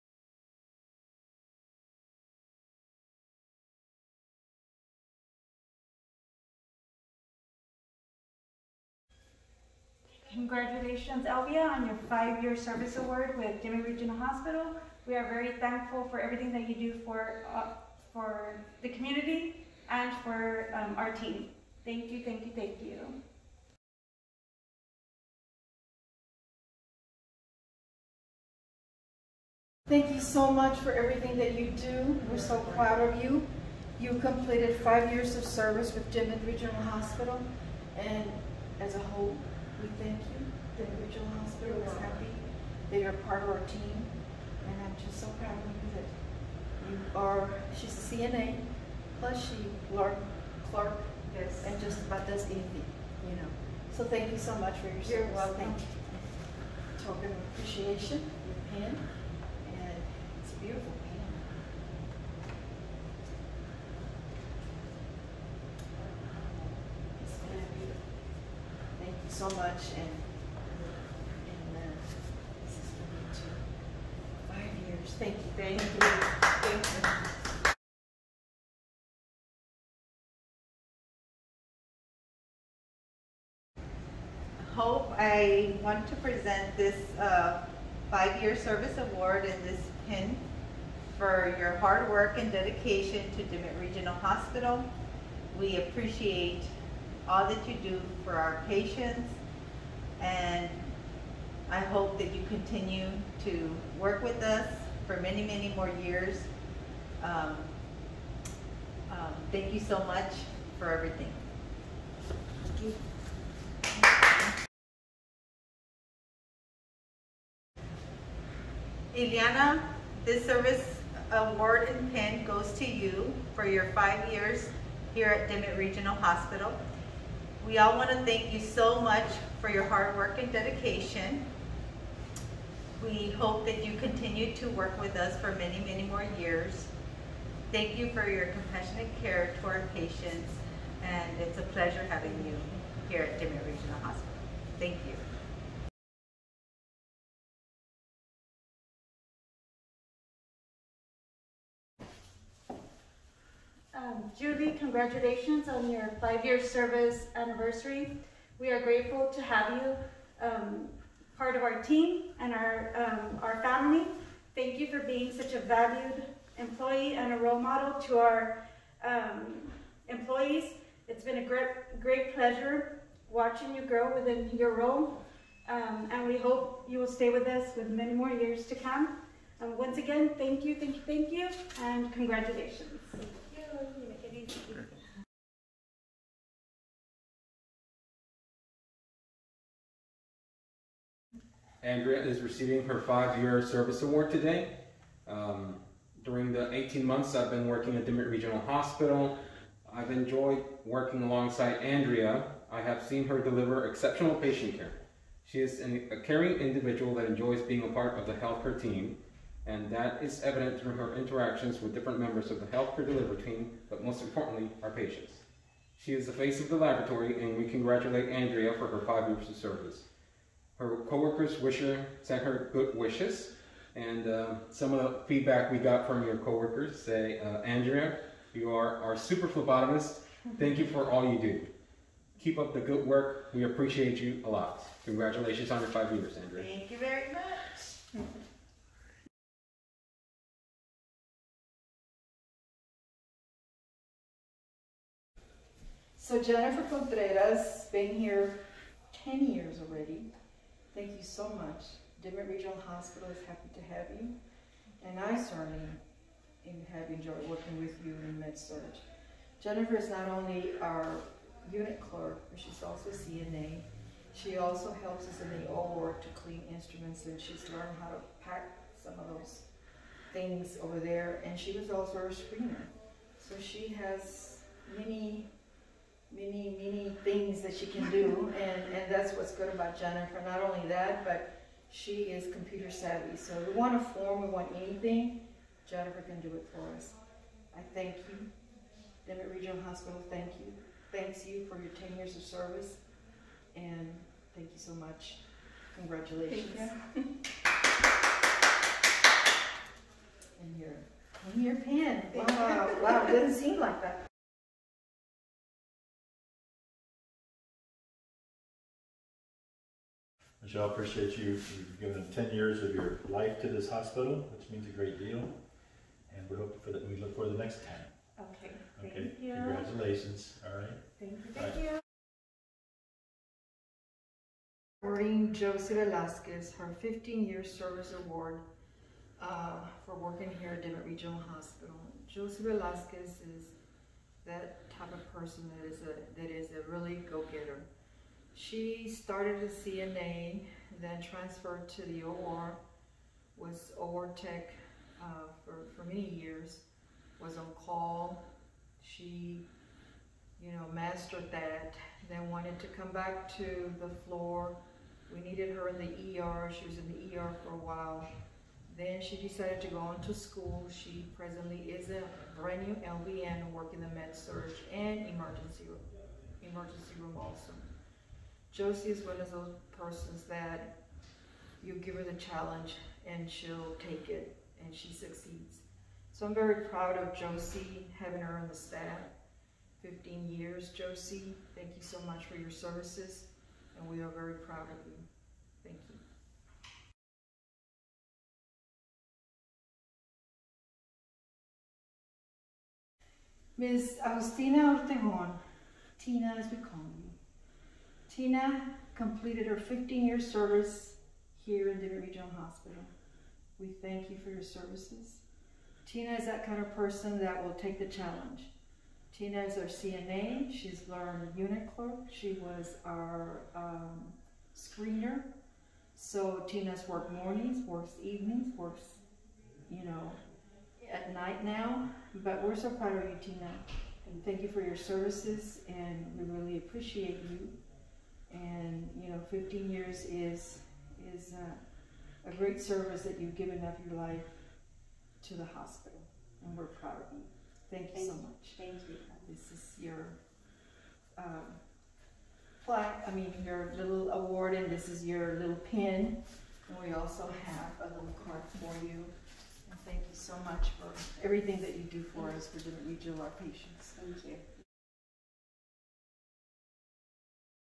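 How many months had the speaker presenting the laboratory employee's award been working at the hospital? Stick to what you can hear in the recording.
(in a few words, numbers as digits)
18.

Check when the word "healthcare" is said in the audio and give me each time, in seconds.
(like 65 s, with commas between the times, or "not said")
208 s, 212 s.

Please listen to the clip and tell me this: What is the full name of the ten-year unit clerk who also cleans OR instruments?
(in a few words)
Jennifer Contreras.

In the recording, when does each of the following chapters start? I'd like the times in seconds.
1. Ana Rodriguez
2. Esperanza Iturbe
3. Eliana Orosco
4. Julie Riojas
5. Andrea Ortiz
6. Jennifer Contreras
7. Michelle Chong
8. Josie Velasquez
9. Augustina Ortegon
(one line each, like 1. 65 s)
1. 24 s
2. 78 s
3. 115 s
4. 146 s
5. 185 s
6. 240 s
7. 304 s
8. 322 s
9. 387 s.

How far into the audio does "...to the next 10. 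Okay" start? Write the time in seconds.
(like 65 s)
317 s.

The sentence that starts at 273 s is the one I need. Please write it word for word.
So she has many many, many things that she can do, and, and that's what's good about Jennifer.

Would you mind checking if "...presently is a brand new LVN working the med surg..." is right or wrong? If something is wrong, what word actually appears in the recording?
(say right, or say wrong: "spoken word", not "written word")
right.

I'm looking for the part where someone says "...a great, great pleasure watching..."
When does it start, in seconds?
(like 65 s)
171 s.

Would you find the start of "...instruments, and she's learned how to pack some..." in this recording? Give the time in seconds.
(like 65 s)
266 s.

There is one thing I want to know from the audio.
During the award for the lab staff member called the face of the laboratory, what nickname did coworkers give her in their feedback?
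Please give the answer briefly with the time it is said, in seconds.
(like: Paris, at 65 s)
super phlebotomist, at 229 s.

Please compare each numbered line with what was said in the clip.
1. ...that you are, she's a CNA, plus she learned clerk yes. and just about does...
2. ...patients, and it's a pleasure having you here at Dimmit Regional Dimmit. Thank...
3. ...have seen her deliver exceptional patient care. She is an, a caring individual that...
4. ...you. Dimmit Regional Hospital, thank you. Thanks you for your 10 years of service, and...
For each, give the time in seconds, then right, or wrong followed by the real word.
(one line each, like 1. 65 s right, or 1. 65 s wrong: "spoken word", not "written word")
1. 45 s right
2. 139 s wrong: "Hospital", not "Dimmit"
3. 202 s right
4. 288 s right.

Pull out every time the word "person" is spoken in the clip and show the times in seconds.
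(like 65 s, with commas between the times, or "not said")
335 s, 369 s, 406 s.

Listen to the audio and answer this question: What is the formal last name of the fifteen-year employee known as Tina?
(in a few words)
Ortegon.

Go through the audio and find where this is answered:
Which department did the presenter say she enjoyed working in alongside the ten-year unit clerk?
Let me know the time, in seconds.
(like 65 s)
258 s.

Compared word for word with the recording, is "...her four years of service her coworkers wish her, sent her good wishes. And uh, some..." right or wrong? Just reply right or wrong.
wrong.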